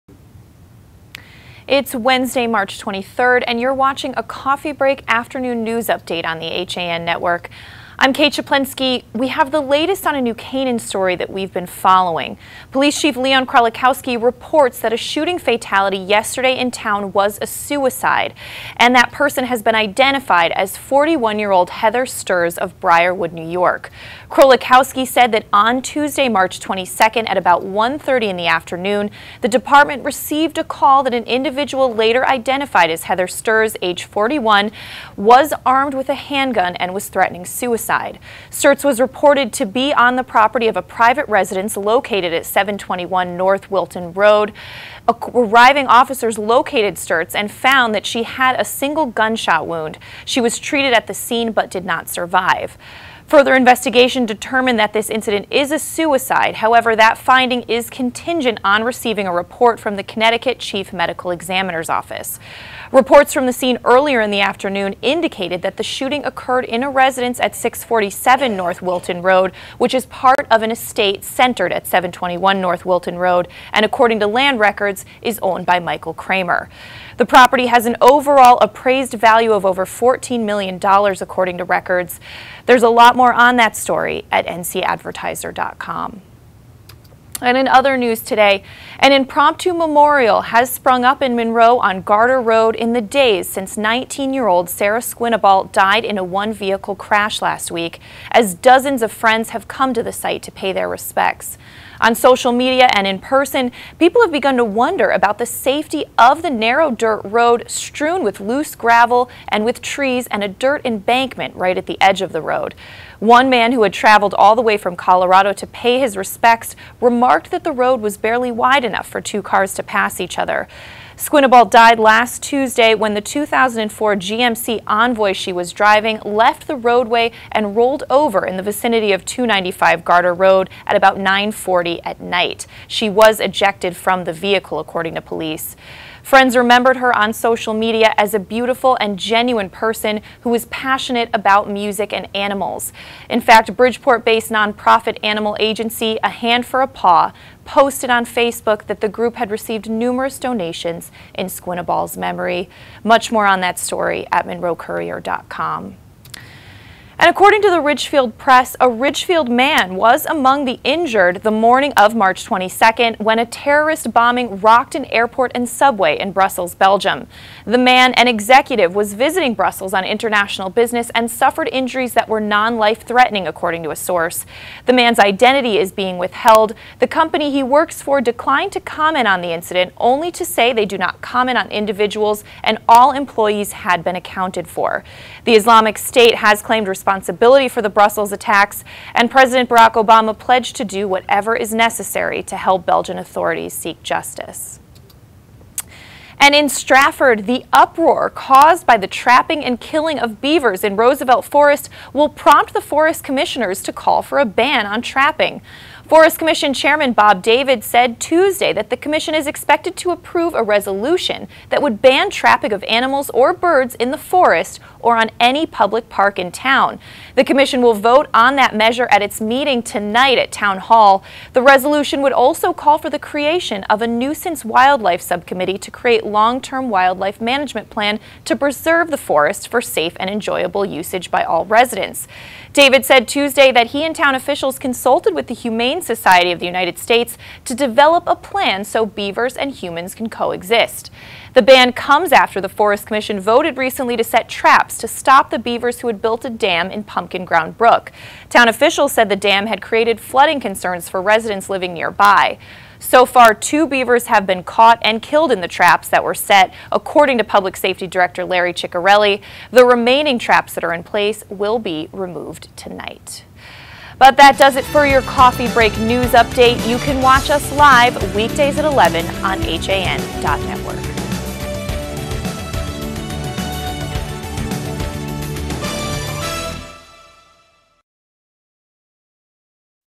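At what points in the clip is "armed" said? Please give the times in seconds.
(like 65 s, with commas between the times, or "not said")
35 s.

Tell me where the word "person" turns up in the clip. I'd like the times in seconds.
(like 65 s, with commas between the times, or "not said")
19 s, 103 s, 139 s.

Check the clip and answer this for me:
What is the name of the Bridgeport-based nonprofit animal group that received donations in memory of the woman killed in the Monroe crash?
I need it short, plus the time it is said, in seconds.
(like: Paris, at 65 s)
A Hand for a Paw, at 146 s.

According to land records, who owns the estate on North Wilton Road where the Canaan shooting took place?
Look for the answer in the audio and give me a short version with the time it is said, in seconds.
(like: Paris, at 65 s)
Michael Kramer, at 75 s.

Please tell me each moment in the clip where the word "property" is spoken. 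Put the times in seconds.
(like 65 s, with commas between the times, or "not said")
40 s, 77 s.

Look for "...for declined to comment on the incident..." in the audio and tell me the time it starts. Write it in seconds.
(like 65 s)
178 s.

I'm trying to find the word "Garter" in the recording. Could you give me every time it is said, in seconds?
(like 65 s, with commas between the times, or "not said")
92 s, 130 s.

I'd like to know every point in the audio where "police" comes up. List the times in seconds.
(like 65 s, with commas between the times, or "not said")
12 s, 135 s.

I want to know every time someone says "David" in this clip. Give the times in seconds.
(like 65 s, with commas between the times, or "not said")
207 s, 232 s.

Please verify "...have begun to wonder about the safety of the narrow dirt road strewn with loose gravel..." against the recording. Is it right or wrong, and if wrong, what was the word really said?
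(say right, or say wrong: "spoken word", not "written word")
right.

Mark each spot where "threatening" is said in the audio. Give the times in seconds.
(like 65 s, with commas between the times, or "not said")
37 s, 173 s.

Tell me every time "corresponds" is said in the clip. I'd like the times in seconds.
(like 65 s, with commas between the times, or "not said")
not said.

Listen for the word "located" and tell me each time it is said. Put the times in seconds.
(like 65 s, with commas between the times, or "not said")
41 s, 46 s.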